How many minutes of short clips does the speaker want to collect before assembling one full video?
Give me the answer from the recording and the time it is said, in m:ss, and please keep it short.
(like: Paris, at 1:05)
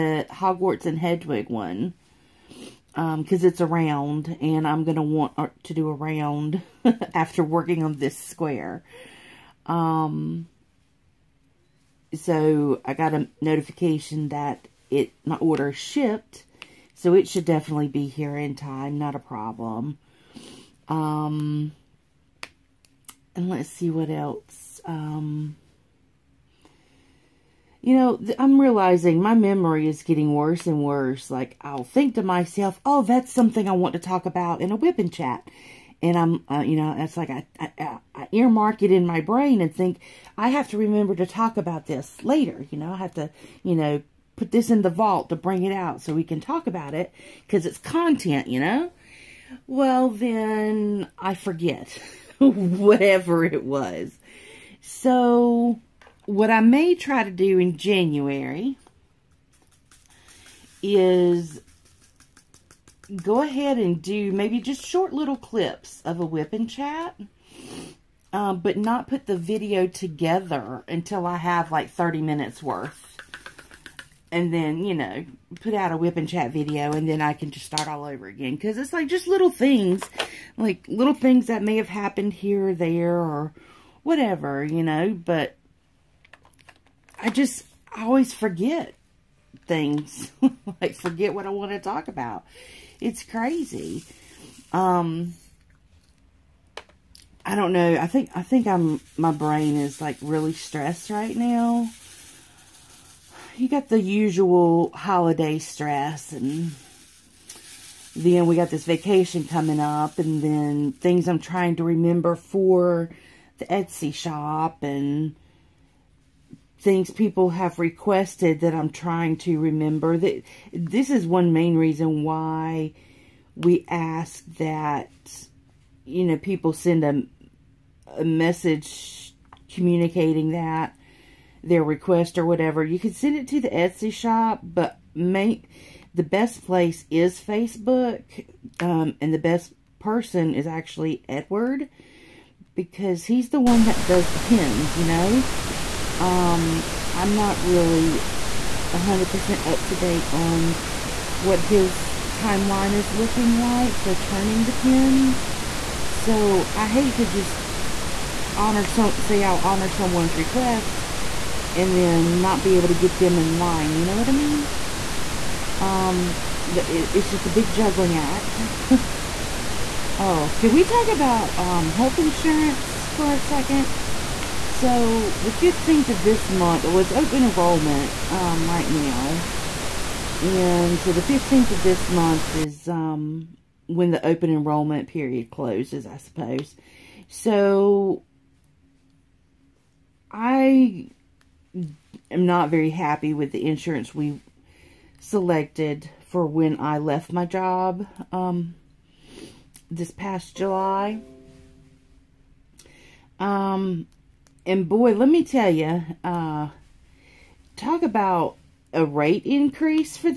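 30, at 1:11.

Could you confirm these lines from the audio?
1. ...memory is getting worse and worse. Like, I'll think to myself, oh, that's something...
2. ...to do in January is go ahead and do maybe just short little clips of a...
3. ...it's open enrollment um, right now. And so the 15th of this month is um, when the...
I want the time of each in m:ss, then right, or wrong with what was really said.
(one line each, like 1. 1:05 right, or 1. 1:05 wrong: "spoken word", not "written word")
1. 0:29 right
2. 0:57 right
3. 2:56 right.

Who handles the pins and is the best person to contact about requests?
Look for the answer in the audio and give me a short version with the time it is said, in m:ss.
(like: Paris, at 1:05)
Edward, at 2:21.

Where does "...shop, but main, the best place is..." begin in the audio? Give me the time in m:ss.
2:14.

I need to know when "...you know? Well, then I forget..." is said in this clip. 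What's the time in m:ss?
0:48.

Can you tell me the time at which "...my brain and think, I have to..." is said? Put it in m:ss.
0:39.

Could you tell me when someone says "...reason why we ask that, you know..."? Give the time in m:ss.
2:01.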